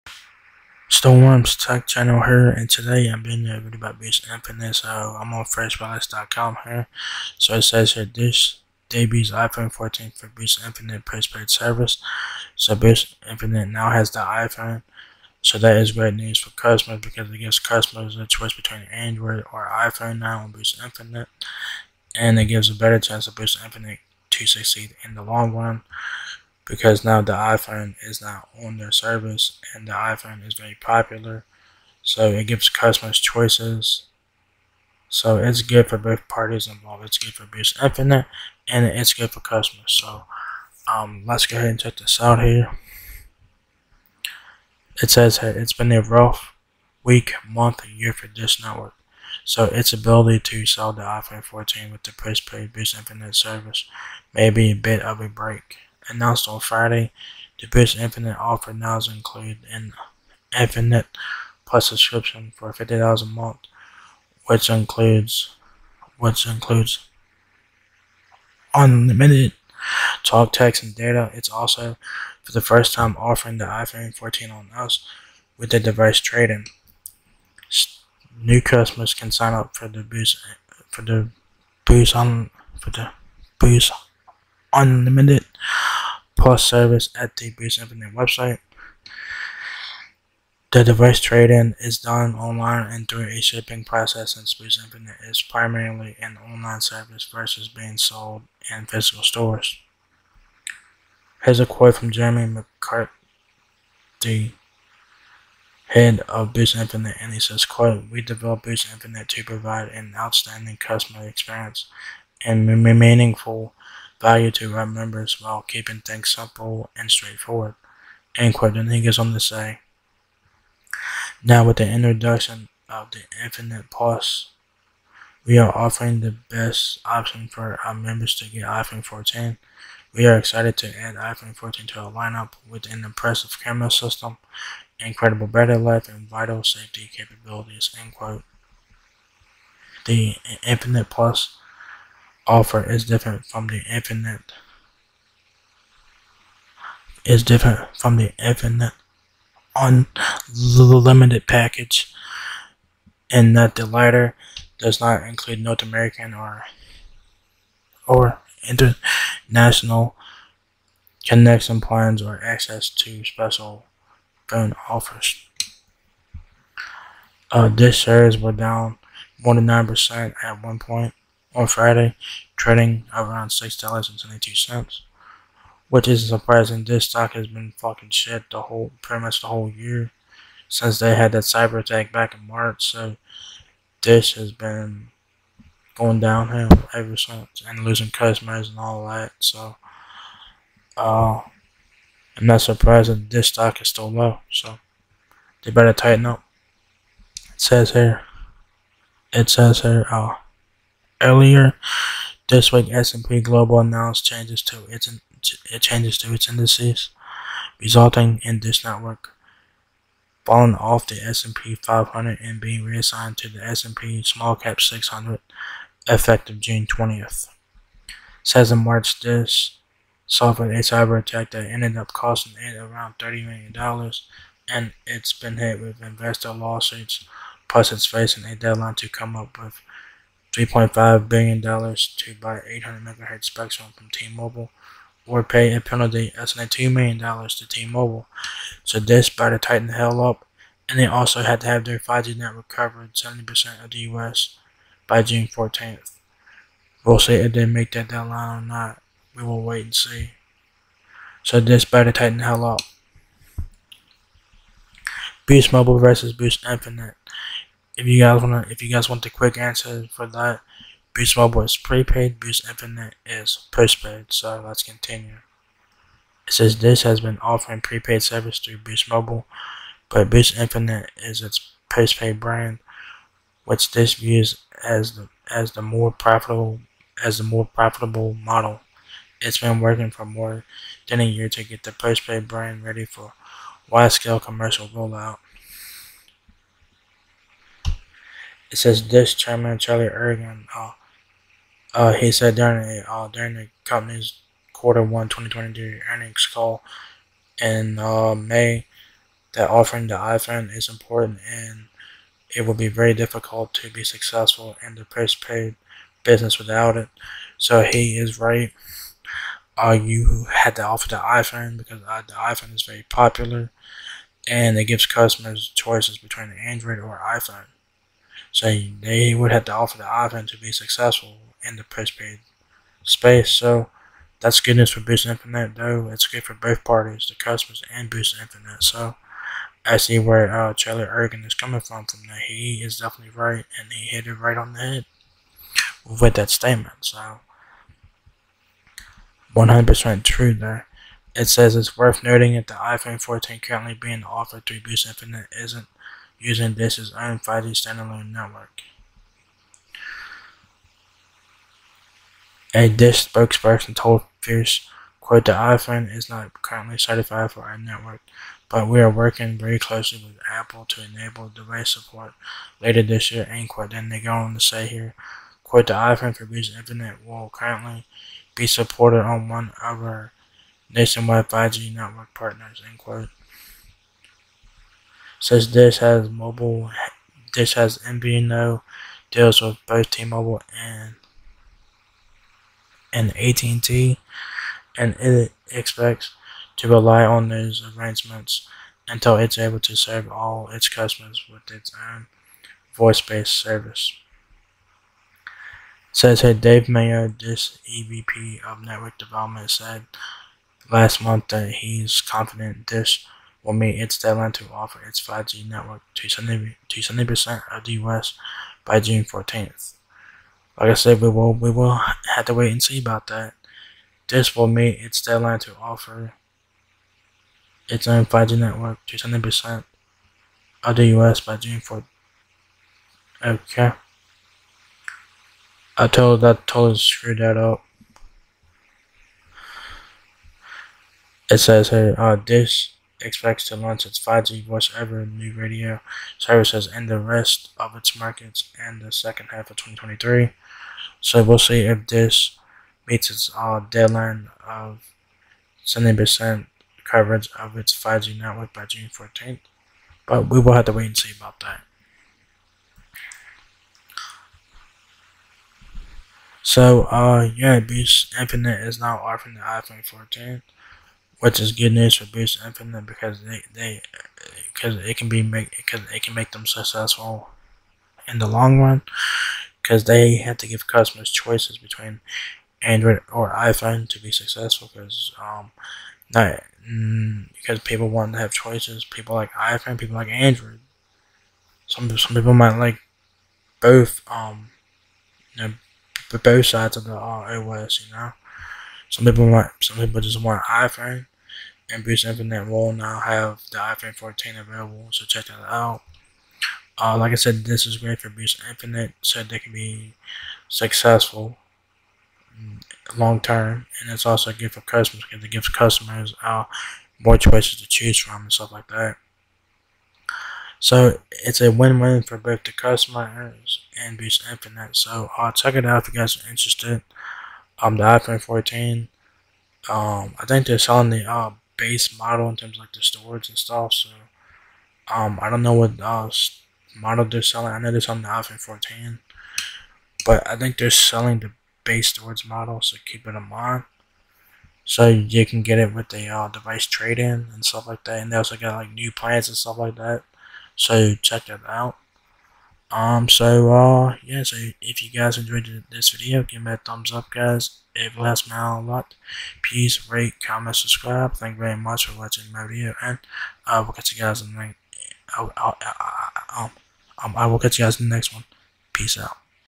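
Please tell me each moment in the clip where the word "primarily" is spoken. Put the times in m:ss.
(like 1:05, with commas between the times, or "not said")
1:35.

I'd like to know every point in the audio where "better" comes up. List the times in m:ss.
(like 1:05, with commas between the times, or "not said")
0:22, 3:15.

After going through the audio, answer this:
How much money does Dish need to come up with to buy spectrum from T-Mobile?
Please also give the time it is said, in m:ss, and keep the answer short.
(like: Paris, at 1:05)
$3.5 billion, at 3:50.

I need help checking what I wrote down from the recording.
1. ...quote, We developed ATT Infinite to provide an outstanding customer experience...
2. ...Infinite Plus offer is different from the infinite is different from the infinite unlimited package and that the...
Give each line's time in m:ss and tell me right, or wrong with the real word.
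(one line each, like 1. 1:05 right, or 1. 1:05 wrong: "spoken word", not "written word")
1. 1:47 wrong: "Boost", not "ATT"
2. 2:20 right.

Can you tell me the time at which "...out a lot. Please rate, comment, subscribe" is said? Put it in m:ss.
9:08.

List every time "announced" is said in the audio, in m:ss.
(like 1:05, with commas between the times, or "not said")
0:56, 3:23.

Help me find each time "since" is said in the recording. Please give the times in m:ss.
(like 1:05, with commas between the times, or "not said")
1:34, 3:00, 3:07, 6:15.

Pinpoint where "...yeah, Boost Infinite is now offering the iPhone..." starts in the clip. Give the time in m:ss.
7:37.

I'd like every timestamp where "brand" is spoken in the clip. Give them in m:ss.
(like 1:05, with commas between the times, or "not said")
4:32, 4:42.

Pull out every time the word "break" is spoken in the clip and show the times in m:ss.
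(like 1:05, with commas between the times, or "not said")
0:55.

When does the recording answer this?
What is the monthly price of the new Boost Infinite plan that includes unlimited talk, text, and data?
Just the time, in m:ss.
1:02.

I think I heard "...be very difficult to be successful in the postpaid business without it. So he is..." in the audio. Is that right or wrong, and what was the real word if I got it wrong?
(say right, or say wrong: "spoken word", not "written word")
right.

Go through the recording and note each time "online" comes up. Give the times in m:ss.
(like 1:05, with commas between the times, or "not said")
1:32, 1:36.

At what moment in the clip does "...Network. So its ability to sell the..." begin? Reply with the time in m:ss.
0:48.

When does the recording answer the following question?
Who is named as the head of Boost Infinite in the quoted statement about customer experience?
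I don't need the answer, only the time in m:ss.
1:42.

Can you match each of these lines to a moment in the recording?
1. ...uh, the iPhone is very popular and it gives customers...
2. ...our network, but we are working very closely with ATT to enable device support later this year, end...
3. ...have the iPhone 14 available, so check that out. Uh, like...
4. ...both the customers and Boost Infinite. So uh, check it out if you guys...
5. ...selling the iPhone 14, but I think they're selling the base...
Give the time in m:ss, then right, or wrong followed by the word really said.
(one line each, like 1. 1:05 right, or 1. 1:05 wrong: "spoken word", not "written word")
1. 5:12 right
2. 5:57 wrong: "Apple", not "ATT"
3. 8:13 right
4. 8:32 right
5. 8:47 right.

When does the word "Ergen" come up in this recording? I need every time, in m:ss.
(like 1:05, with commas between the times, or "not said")
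4:50, 5:31.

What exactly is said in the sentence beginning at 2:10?
We are excited to add iPhone 14 to our lineup with an impressive camera system, incredible battery life, and vital safety capabilities.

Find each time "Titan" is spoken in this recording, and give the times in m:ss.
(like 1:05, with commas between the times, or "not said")
3:59, 4:12.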